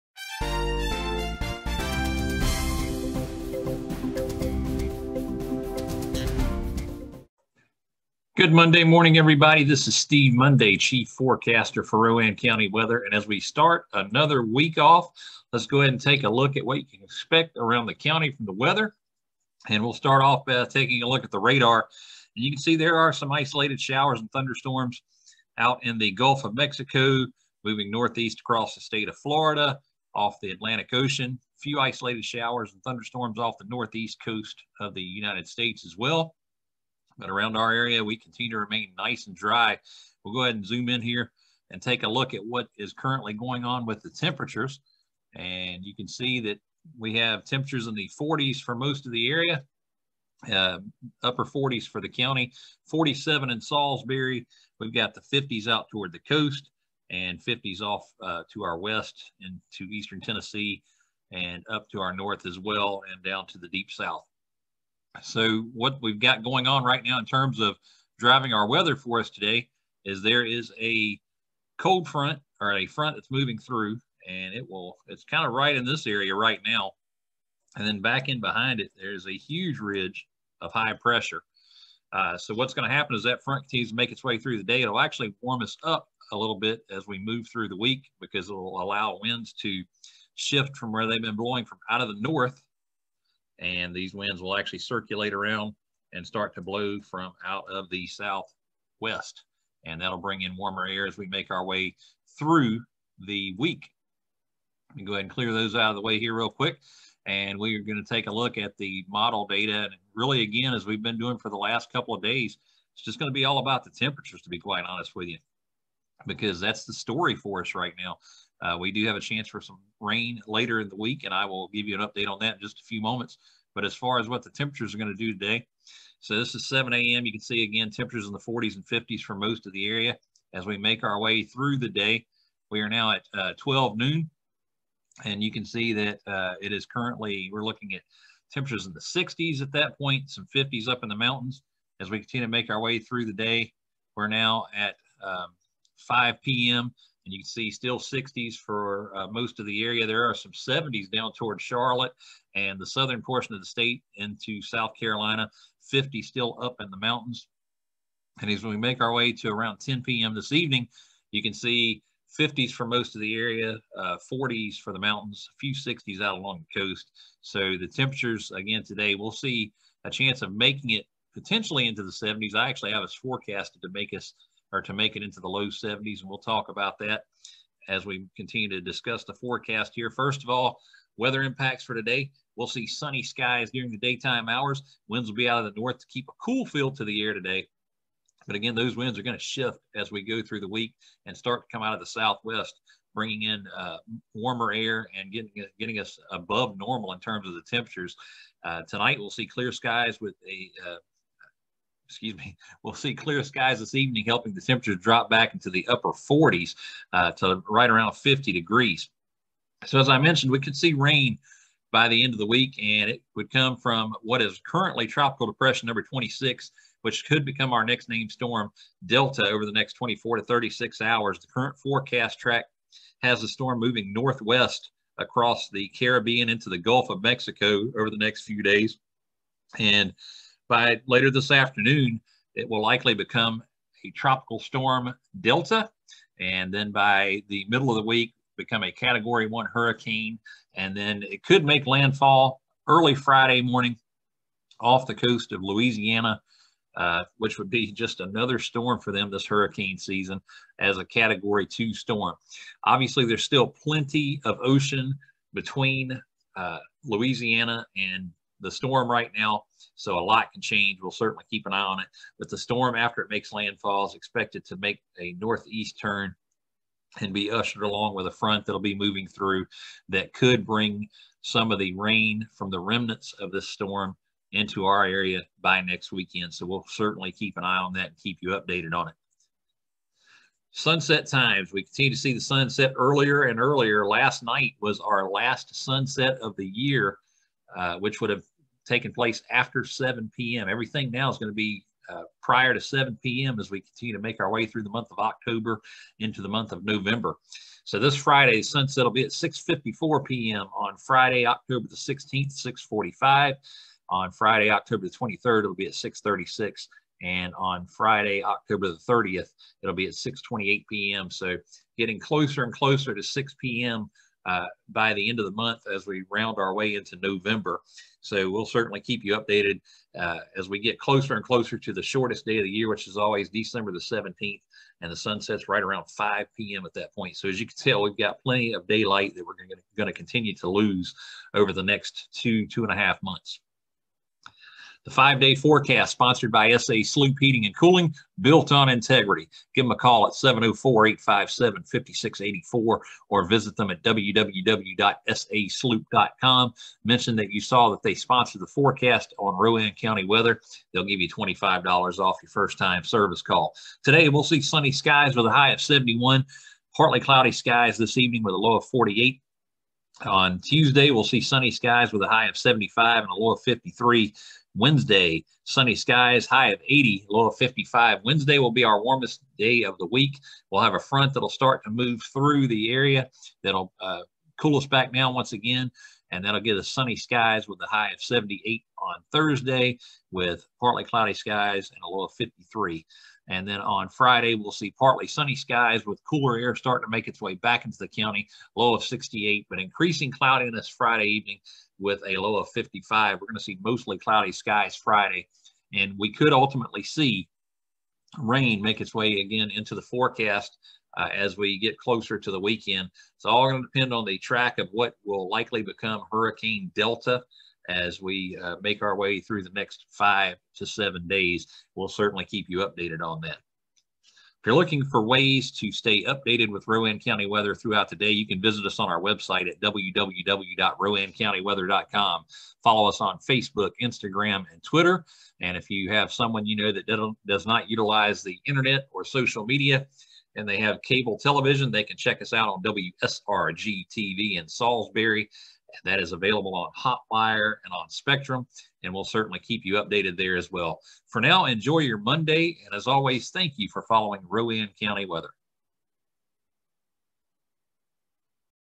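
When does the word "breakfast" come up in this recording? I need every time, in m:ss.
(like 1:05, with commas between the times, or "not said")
not said.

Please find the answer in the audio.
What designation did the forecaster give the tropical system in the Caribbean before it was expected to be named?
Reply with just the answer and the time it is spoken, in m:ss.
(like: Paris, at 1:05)
Tropical depression number 26, at 3:35.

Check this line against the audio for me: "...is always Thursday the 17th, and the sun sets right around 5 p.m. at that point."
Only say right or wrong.
wrong.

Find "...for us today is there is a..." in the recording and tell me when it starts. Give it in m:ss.
1:08.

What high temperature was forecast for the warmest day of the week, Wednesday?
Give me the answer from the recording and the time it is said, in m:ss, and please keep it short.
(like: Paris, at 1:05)
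80, at 6:06.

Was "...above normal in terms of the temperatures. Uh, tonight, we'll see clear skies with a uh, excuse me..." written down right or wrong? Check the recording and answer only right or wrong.
right.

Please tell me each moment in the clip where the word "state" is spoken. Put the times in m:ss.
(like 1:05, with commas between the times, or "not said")
0:28, 0:35, 2:33.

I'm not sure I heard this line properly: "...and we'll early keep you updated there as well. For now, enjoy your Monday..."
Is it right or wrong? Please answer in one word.
wrong.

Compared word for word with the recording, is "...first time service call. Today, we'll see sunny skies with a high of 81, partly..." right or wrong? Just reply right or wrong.
wrong.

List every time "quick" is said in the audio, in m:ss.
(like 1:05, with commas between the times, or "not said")
1:46.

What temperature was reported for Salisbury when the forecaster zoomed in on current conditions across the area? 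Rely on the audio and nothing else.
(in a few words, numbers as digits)
47.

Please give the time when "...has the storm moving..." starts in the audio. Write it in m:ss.
3:43.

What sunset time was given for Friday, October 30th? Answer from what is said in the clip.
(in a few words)
6:28 p.m.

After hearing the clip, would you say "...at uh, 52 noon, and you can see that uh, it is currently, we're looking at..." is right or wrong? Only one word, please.
wrong.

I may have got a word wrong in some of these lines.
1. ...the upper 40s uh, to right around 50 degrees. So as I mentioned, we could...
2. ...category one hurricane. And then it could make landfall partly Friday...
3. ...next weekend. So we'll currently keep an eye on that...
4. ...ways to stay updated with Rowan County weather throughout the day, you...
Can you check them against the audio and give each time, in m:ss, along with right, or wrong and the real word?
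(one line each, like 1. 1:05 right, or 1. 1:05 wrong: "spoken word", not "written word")
1. 3:25 right
2. 3:58 wrong: "early", not "partly"
3. 4:35 wrong: "certainly", not "currently"
4. 6:55 right.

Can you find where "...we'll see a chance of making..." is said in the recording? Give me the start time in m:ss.
2:49.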